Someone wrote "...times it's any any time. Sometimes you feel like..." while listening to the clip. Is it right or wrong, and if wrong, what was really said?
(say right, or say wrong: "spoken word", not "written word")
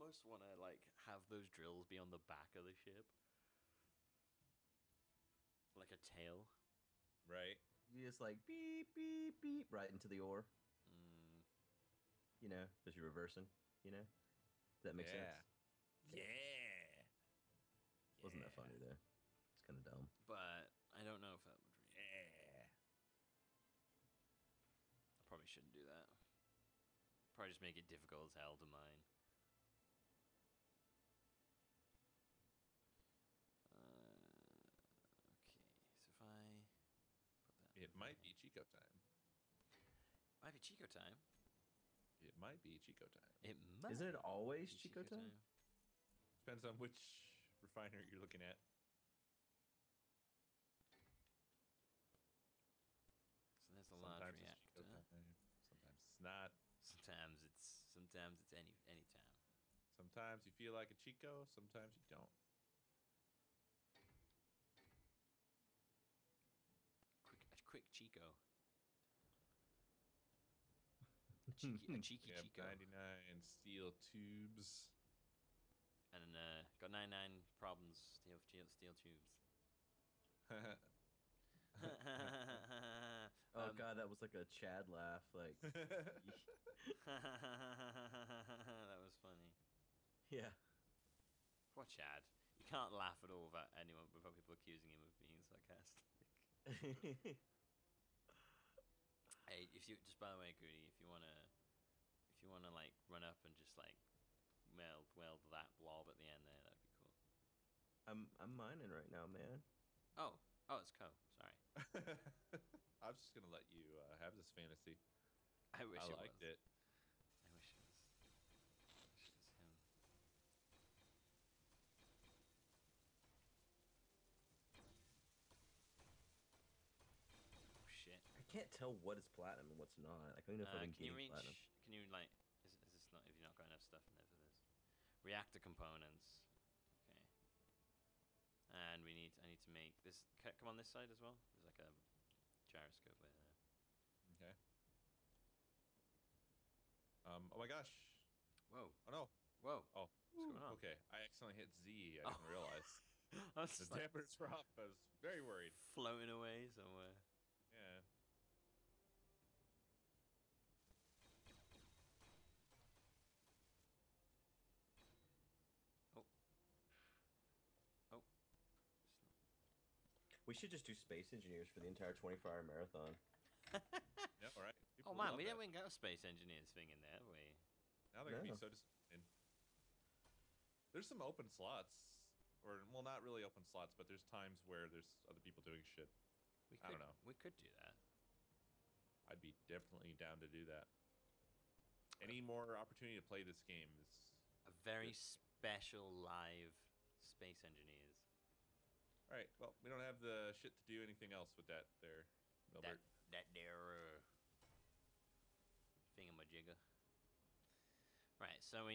wrong: "sometimes", not "times".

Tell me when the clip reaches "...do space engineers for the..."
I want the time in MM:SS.
02:50.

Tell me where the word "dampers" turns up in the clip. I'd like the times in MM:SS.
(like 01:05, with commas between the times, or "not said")
02:34.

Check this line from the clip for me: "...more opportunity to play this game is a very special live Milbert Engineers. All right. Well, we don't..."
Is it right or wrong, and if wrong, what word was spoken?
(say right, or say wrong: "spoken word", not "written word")
wrong: "Space", not "Milbert".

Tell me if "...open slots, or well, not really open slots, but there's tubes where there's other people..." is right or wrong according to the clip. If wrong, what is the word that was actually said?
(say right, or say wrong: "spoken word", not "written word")
wrong: "times", not "tubes".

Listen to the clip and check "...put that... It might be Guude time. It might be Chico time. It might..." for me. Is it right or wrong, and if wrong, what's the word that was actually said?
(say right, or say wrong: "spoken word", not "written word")
wrong: "Chico", not "Guude".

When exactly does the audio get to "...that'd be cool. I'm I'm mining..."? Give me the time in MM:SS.
01:46.